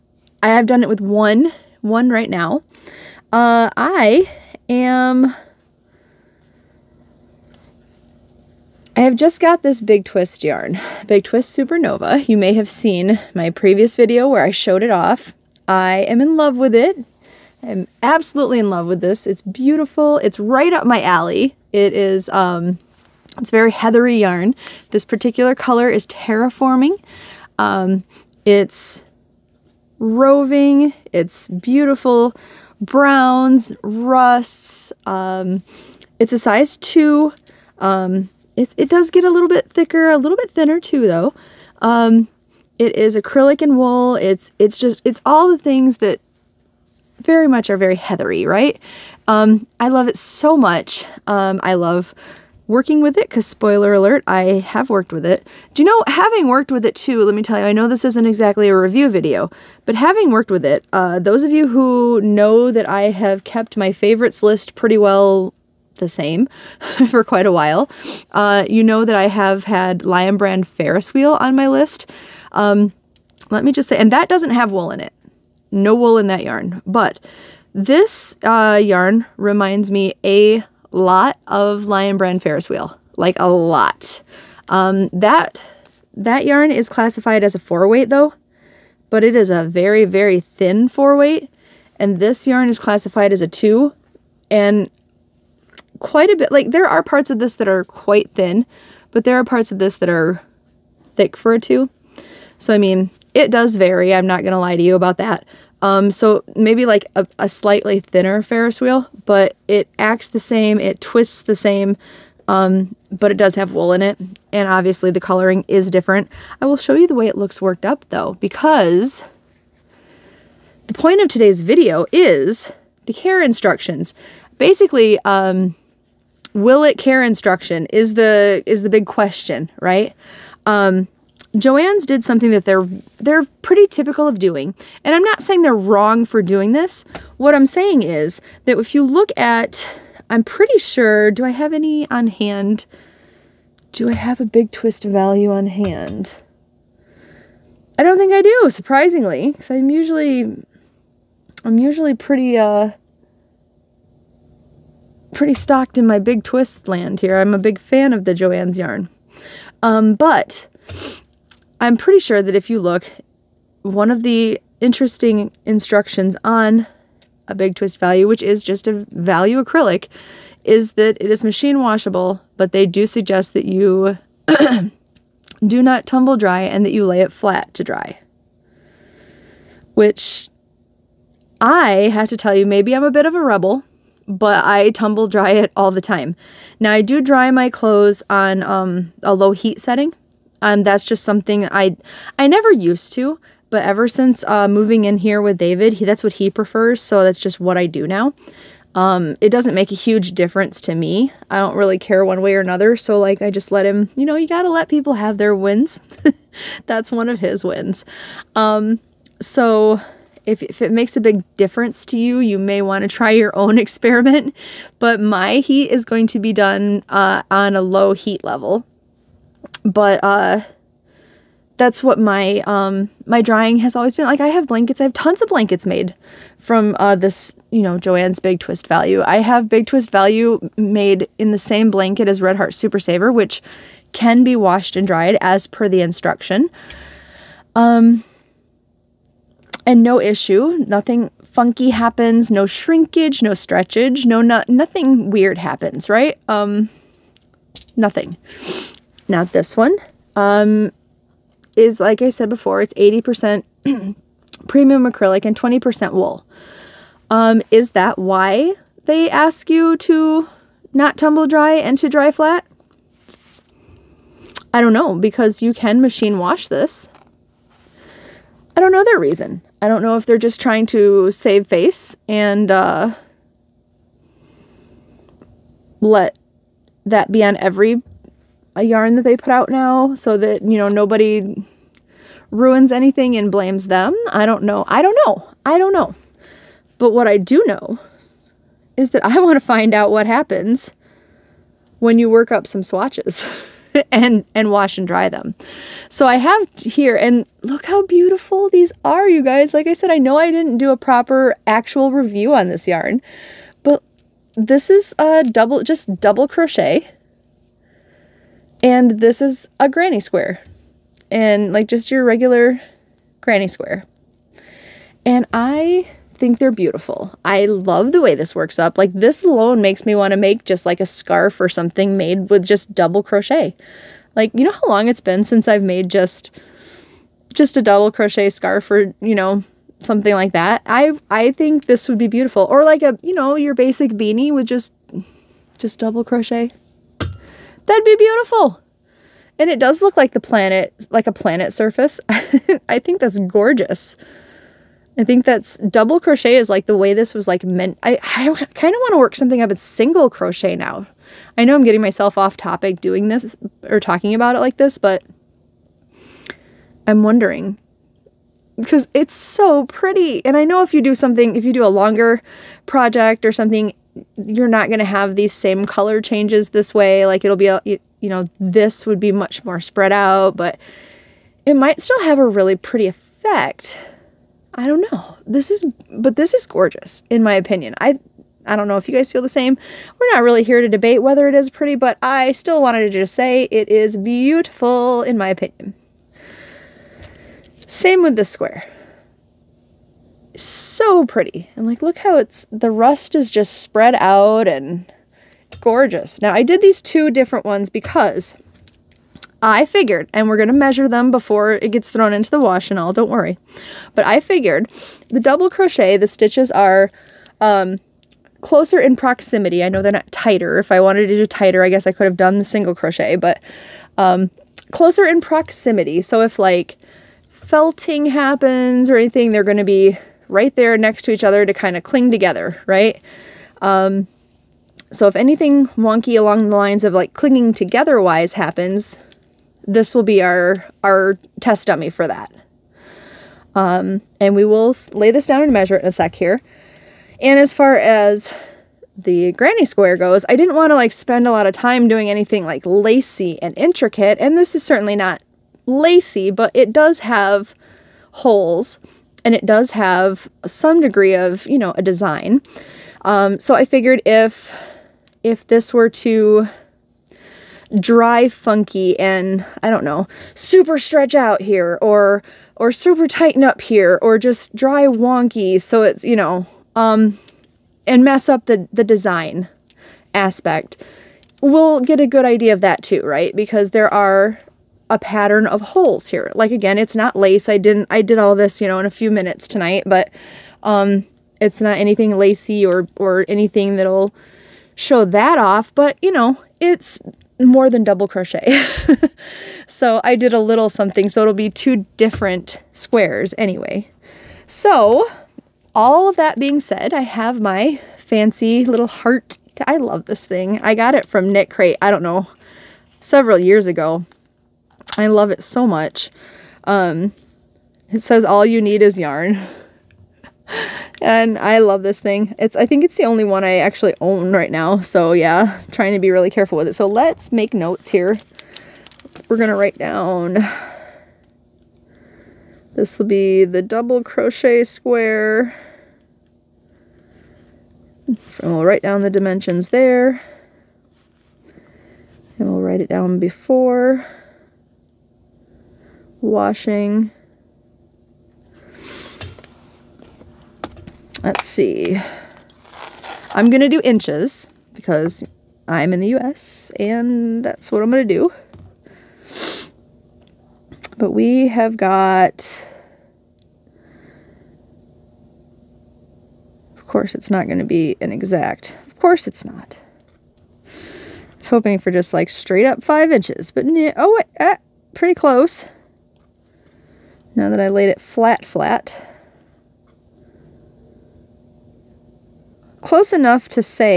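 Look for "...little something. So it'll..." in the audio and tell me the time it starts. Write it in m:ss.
8:10.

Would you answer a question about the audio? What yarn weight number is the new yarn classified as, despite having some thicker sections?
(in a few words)
2.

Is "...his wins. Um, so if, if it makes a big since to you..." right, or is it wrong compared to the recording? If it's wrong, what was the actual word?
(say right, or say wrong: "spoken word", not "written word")
wrong: "difference", not "since".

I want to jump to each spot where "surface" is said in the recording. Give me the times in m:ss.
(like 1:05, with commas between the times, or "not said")
5:41.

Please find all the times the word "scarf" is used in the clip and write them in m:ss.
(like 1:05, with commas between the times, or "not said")
5:21, 5:28.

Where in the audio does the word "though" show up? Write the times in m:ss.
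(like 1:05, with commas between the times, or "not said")
0:41, 1:28, 1:58.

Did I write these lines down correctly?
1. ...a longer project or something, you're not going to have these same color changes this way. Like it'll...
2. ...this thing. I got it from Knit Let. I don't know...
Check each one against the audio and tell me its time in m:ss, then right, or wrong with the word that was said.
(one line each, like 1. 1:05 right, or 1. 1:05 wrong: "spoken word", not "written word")
1. 6:01 right
2. 8:20 wrong: "Crate", not "Let".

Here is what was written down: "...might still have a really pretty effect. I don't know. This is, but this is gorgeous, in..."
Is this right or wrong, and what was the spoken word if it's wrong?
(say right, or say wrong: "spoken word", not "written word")
right.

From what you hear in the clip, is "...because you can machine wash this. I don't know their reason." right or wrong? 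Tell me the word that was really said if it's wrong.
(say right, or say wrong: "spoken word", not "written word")
right.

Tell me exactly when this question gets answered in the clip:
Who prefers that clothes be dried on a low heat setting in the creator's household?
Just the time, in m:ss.
3:15.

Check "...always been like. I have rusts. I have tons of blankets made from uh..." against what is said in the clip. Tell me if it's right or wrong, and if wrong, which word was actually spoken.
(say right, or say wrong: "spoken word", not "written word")
wrong: "blankets", not "rusts".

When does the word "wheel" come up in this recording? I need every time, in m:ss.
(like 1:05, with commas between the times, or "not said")
1:11, 1:22, 1:48.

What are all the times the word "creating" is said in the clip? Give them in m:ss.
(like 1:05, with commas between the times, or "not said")
not said.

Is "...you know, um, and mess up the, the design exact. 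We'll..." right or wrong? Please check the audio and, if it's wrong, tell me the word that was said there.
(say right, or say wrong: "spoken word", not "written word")
wrong: "aspect", not "exact".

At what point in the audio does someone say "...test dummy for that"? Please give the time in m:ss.
7:11.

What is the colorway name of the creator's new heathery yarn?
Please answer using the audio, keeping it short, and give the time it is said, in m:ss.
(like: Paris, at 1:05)
Terraforming, at 0:26.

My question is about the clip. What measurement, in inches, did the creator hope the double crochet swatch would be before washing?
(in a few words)
5 inches.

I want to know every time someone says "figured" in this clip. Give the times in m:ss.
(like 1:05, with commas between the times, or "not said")
6:39, 6:44, 7:33.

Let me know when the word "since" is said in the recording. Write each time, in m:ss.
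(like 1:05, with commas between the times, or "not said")
3:14, 5:25.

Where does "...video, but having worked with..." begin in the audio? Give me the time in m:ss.
0:59.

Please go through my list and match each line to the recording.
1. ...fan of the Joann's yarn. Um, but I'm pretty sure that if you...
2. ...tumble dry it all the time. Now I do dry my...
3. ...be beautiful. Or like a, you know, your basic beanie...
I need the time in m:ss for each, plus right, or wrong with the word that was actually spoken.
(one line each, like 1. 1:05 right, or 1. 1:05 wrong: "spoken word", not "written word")
1. 2:37 right
2. 3:04 right
3. 5:32 right.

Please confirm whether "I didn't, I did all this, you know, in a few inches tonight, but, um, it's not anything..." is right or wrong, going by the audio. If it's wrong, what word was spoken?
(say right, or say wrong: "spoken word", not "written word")
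wrong: "minutes", not "inches".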